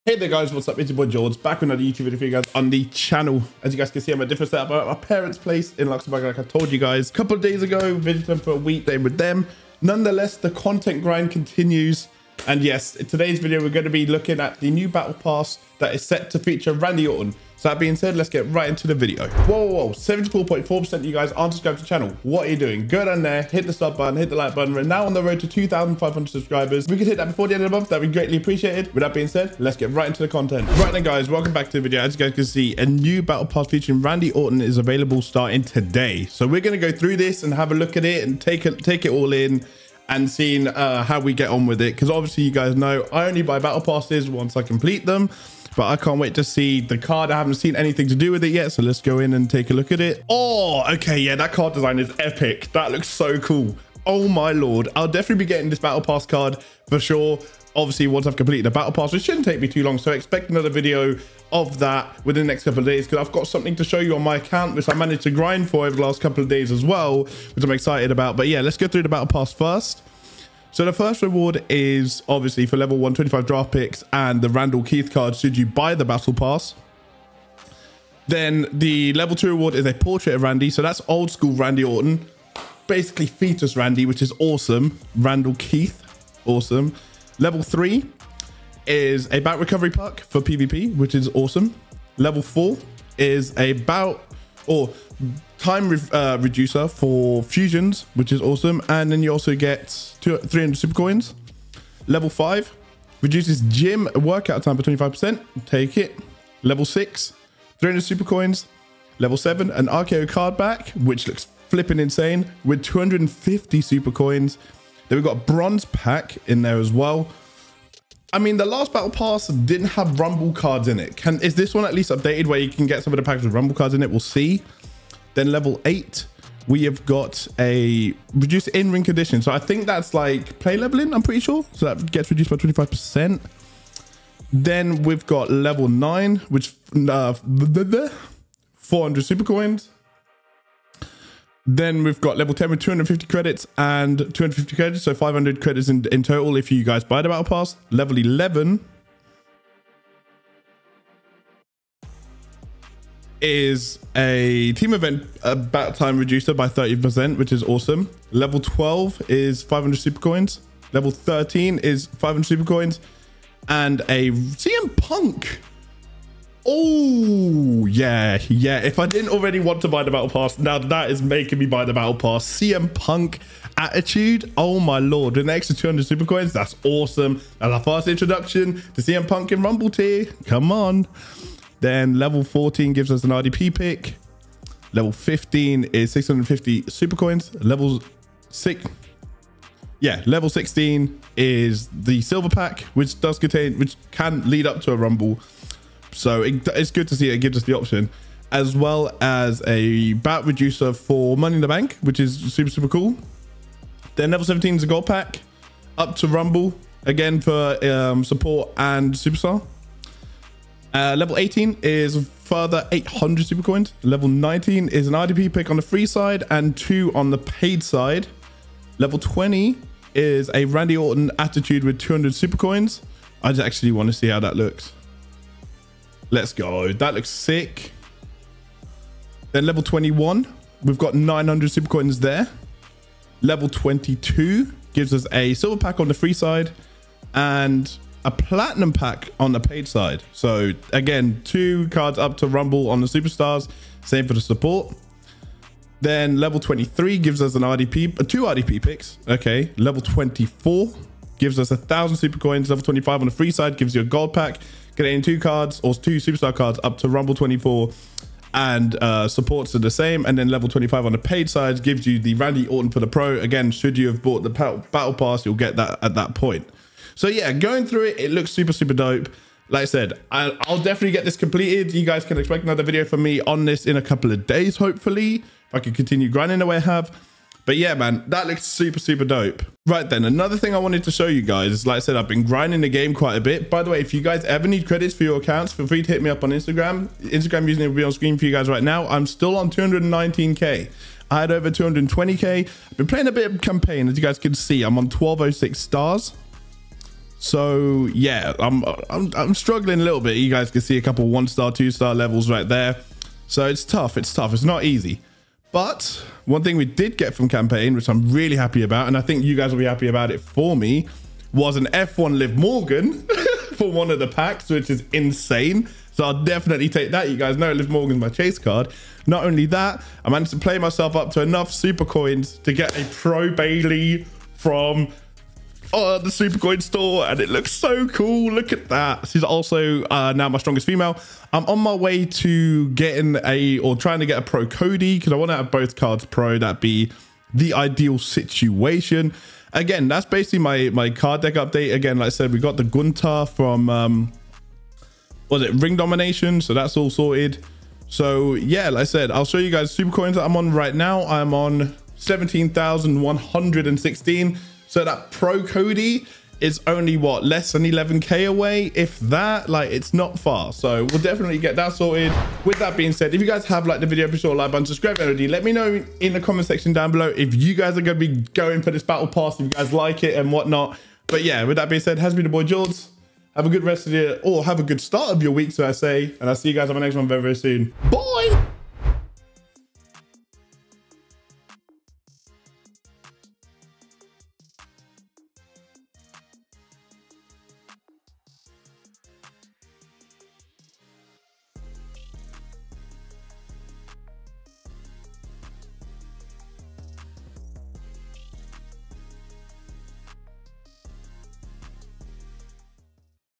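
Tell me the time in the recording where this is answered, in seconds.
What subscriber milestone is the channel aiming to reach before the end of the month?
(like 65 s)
25 s.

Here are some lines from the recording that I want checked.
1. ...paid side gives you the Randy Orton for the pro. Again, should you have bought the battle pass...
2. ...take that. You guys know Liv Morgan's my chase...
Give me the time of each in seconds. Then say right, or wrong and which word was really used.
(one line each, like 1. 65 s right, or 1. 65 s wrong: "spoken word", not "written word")
1. 261 s right
2. 316 s right.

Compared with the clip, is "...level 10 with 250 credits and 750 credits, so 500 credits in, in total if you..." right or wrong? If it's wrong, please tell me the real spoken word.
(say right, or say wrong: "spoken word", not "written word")
wrong: "250", not "750".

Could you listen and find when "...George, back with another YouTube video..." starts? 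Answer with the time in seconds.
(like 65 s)
1 s.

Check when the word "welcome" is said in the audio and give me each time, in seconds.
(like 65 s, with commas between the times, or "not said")
31 s.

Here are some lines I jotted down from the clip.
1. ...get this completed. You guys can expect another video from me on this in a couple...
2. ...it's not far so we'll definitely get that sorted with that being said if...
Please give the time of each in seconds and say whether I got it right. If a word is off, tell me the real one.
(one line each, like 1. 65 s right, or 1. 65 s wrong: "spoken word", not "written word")
1. 271 s right
2. 359 s right.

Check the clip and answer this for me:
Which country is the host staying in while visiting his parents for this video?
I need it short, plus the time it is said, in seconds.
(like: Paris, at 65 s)
Luxembourg, at 5 s.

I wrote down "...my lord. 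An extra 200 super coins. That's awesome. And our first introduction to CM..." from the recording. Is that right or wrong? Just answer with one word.
right.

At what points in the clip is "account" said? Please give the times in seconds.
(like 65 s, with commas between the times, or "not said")
64 s, 285 s.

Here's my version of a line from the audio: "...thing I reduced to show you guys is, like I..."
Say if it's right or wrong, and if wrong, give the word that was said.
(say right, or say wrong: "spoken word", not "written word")
wrong: "wanted", not "reduced".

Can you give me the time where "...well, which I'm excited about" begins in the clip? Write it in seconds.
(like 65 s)
66 s.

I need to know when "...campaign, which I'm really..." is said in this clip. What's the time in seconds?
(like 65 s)
307 s.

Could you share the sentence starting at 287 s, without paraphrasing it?
Instagram username will be on screen for you guys right now.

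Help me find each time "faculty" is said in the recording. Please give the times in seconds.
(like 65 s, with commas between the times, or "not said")
not said.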